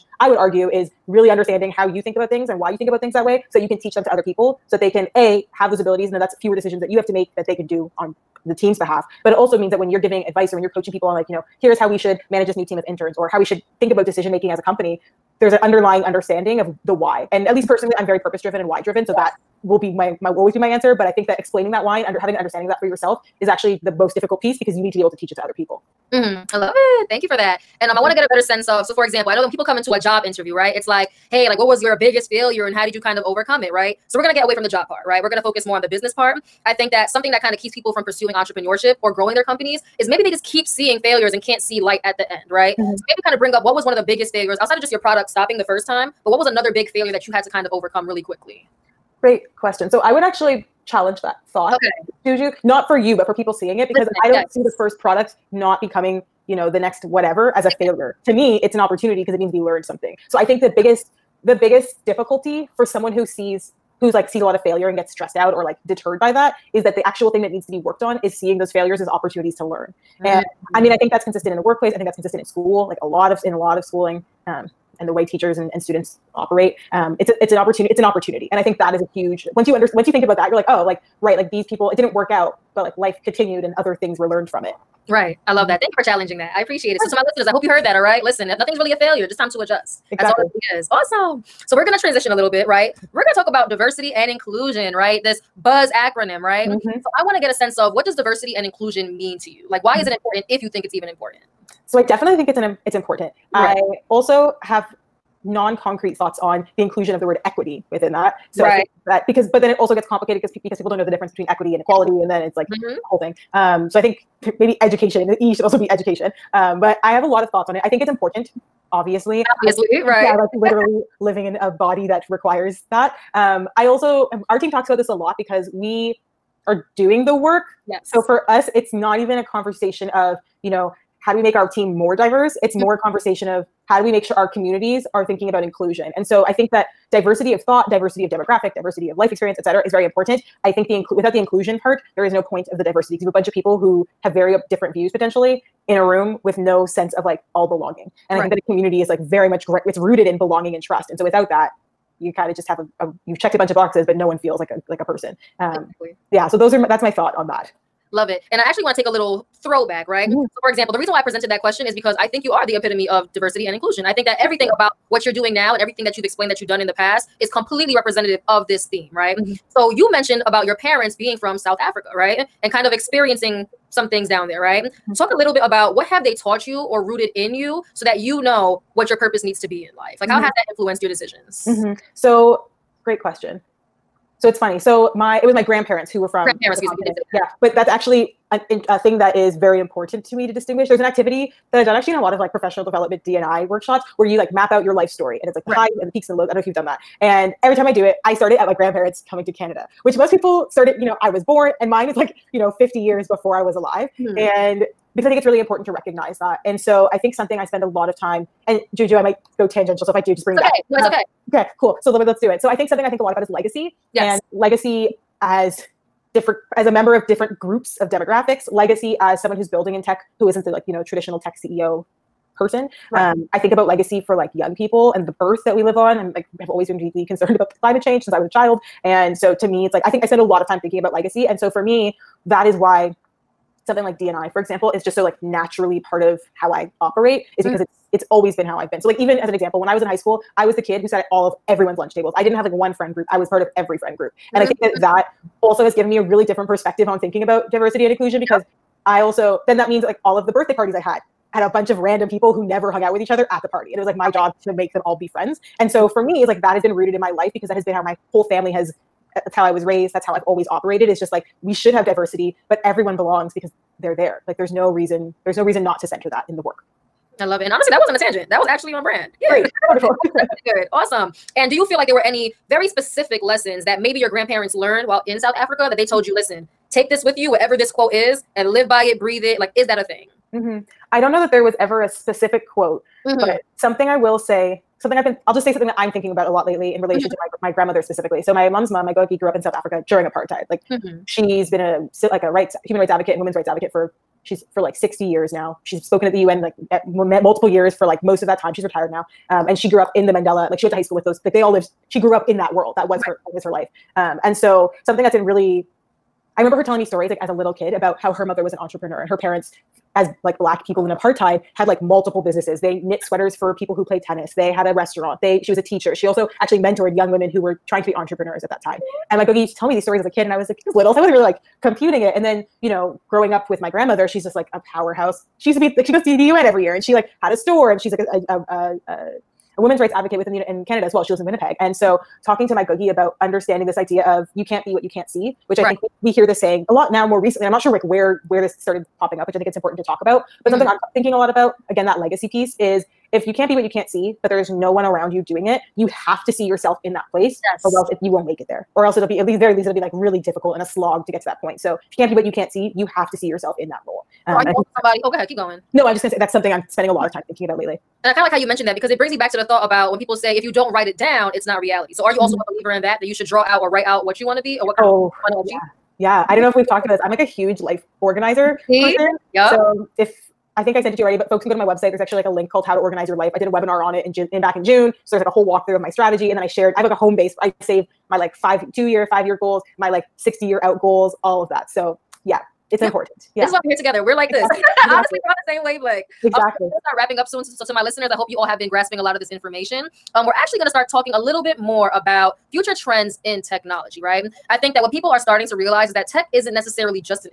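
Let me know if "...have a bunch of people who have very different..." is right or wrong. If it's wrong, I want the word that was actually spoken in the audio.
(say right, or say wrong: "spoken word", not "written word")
right.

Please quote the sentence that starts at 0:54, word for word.
see this first product not becoming, you know, the next whatever as a failure.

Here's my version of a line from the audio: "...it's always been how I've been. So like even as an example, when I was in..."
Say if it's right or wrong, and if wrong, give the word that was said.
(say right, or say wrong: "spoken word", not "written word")
right.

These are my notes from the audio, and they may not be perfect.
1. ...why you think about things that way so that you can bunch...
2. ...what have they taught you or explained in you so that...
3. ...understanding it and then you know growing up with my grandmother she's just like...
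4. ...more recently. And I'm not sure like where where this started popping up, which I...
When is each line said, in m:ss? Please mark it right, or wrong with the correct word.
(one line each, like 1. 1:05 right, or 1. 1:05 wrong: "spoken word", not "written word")
1. 0:02 wrong: "teach", not "bunch"
2. 2:55 wrong: "rooted", not "explained"
3. 5:21 wrong: "computing", not "understanding"
4. 5:37 right.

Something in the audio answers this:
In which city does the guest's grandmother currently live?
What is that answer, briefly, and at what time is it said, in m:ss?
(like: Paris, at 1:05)
Winnipeg, at 5:31.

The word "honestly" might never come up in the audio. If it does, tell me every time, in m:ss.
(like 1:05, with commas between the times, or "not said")
4:27, 6:25.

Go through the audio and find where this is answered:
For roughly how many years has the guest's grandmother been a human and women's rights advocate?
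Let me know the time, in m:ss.
4:54.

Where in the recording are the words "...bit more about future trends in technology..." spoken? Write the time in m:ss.
6:31.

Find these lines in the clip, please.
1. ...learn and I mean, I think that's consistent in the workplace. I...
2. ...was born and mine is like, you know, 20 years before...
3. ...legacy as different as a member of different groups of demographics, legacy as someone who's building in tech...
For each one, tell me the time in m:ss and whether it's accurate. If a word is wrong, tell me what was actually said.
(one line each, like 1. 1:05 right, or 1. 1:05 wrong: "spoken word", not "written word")
1. 1:09 right
2. 3:21 wrong: "50", not "20"
3. 3:34 right.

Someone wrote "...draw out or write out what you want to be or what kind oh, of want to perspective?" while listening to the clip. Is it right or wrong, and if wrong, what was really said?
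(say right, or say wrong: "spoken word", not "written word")
wrong: "achieve", not "perspective".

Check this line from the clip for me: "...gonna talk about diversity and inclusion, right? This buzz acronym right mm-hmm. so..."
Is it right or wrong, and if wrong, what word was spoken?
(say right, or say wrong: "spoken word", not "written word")
right.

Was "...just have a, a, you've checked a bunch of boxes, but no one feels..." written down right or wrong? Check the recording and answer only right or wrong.
right.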